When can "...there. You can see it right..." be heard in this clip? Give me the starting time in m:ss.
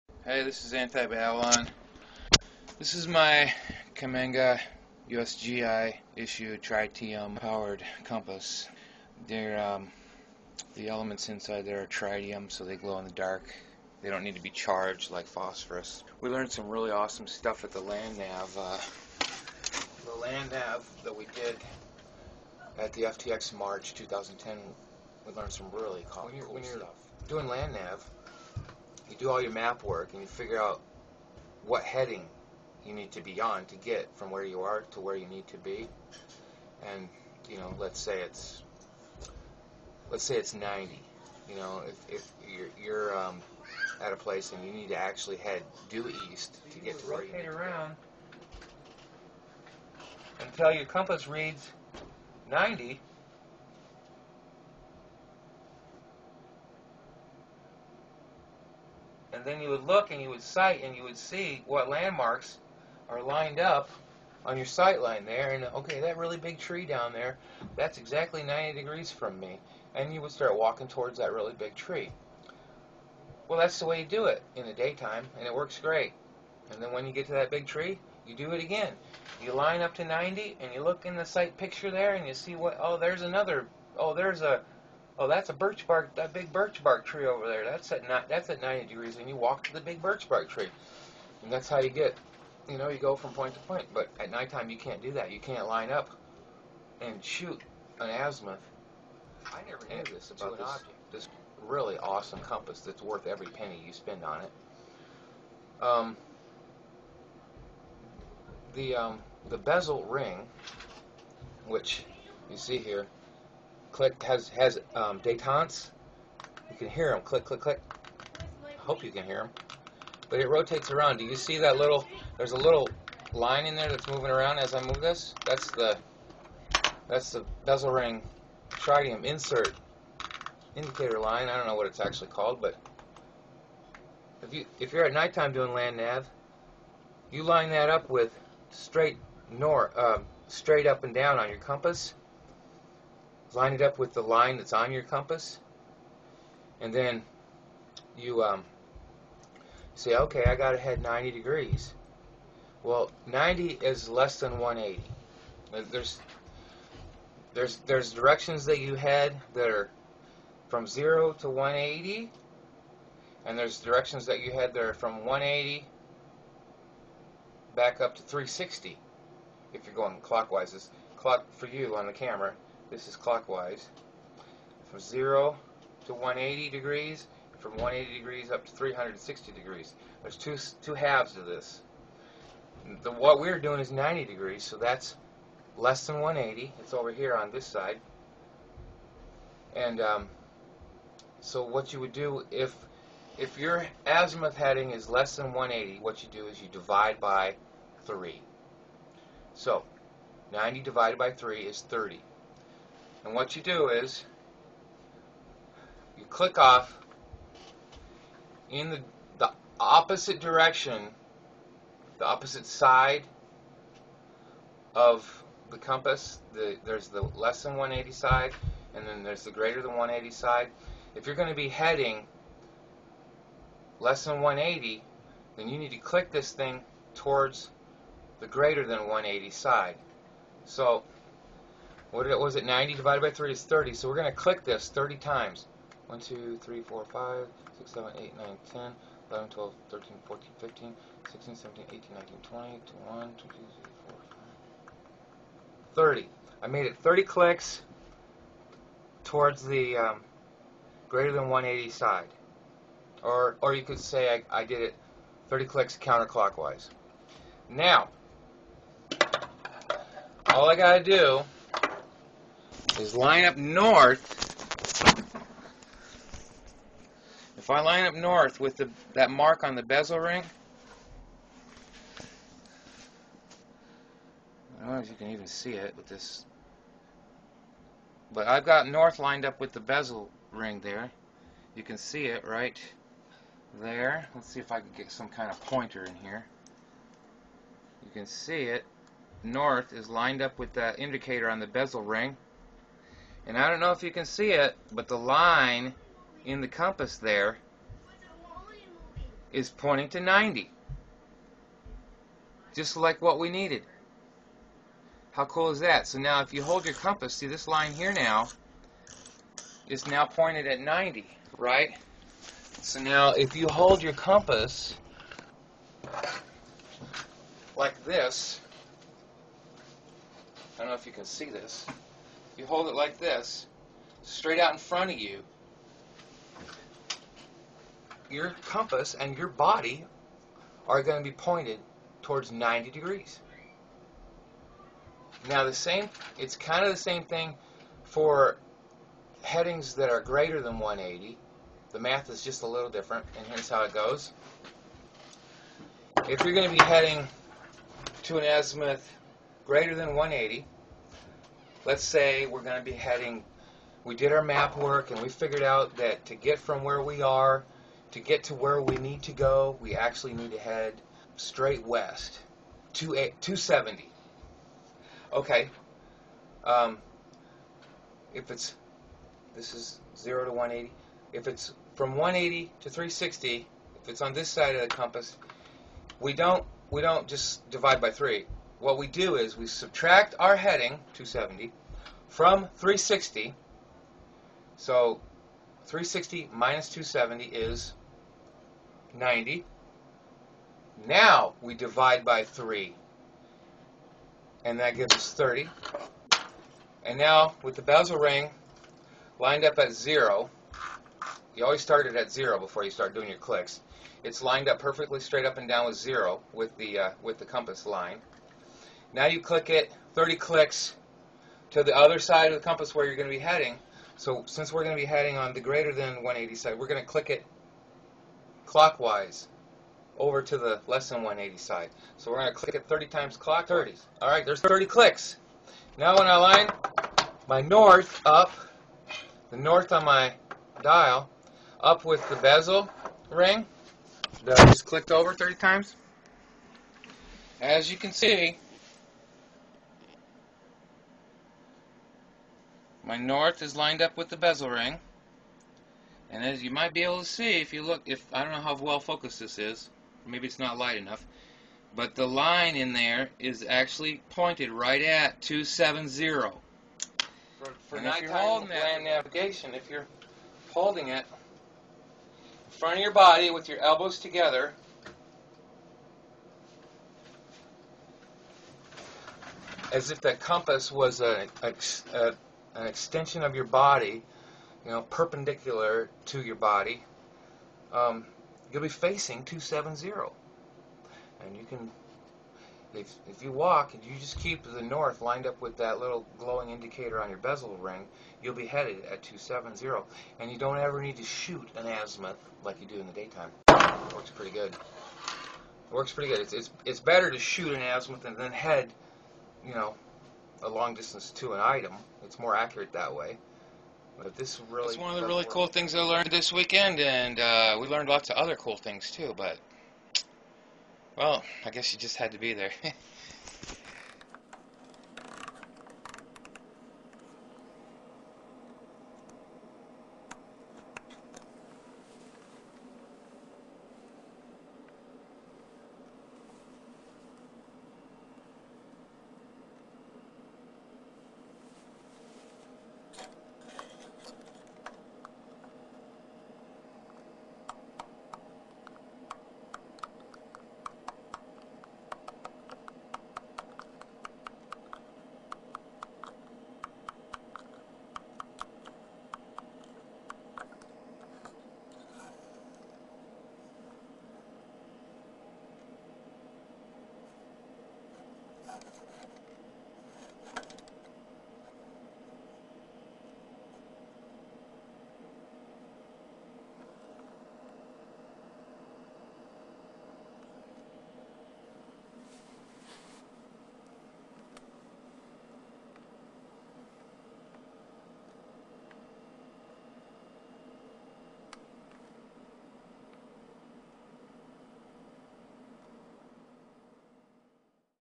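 4:40.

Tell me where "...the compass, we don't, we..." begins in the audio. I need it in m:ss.
6:14.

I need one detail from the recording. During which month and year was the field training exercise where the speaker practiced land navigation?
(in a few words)
March 2010.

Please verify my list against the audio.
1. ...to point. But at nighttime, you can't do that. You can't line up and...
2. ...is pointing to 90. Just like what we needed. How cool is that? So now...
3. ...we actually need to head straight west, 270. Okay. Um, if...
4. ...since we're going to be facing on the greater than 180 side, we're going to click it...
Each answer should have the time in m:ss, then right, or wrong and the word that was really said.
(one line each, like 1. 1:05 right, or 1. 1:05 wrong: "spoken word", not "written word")
1. 1:33 right
2. 4:59 right
3. 5:59 right
4. 6:54 wrong: "heading", not "facing".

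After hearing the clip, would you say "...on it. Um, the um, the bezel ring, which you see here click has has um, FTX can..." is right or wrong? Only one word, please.
wrong.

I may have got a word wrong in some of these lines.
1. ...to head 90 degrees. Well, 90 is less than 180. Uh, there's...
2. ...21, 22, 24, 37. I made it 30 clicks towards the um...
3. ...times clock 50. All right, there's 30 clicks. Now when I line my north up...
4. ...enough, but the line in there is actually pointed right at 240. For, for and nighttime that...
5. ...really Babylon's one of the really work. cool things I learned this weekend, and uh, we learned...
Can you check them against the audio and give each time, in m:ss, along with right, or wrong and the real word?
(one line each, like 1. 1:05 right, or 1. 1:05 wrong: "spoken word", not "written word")
1. 2:30 right
2. 4:03 wrong: "30", not "37"
3. 7:03 wrong: "30", not "50"
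4. 7:30 wrong: "270", not "240"
5. 8:24 wrong: "That", not "Babylon".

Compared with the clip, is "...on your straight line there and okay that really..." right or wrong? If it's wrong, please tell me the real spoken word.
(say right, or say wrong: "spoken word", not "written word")
wrong: "sight", not "straight".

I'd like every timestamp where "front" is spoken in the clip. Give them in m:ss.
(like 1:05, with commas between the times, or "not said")
5:24, 7:42.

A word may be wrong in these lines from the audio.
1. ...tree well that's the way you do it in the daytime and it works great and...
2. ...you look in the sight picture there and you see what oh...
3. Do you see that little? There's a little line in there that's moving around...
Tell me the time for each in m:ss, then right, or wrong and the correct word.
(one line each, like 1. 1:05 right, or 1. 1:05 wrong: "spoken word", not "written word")
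1. 1:11 right
2. 1:20 right
3. 2:01 right.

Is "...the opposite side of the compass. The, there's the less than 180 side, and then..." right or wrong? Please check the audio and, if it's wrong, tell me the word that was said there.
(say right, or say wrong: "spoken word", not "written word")
right.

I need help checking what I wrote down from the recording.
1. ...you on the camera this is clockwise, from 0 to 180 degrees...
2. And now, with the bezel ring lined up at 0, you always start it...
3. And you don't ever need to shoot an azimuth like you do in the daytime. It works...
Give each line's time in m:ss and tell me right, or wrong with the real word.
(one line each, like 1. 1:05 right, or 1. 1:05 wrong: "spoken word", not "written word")
1. 2:51 right
2. 6:37 right
3. 8:10 right.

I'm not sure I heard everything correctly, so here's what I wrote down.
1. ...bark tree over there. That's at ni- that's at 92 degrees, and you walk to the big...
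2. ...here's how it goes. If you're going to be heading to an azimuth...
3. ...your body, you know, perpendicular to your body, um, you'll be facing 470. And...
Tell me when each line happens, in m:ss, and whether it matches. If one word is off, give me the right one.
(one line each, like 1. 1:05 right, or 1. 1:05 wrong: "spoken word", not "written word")
1. 1:26 wrong: "90", not "92"
2. 5:43 right
3. 7:53 wrong: "270", not "470".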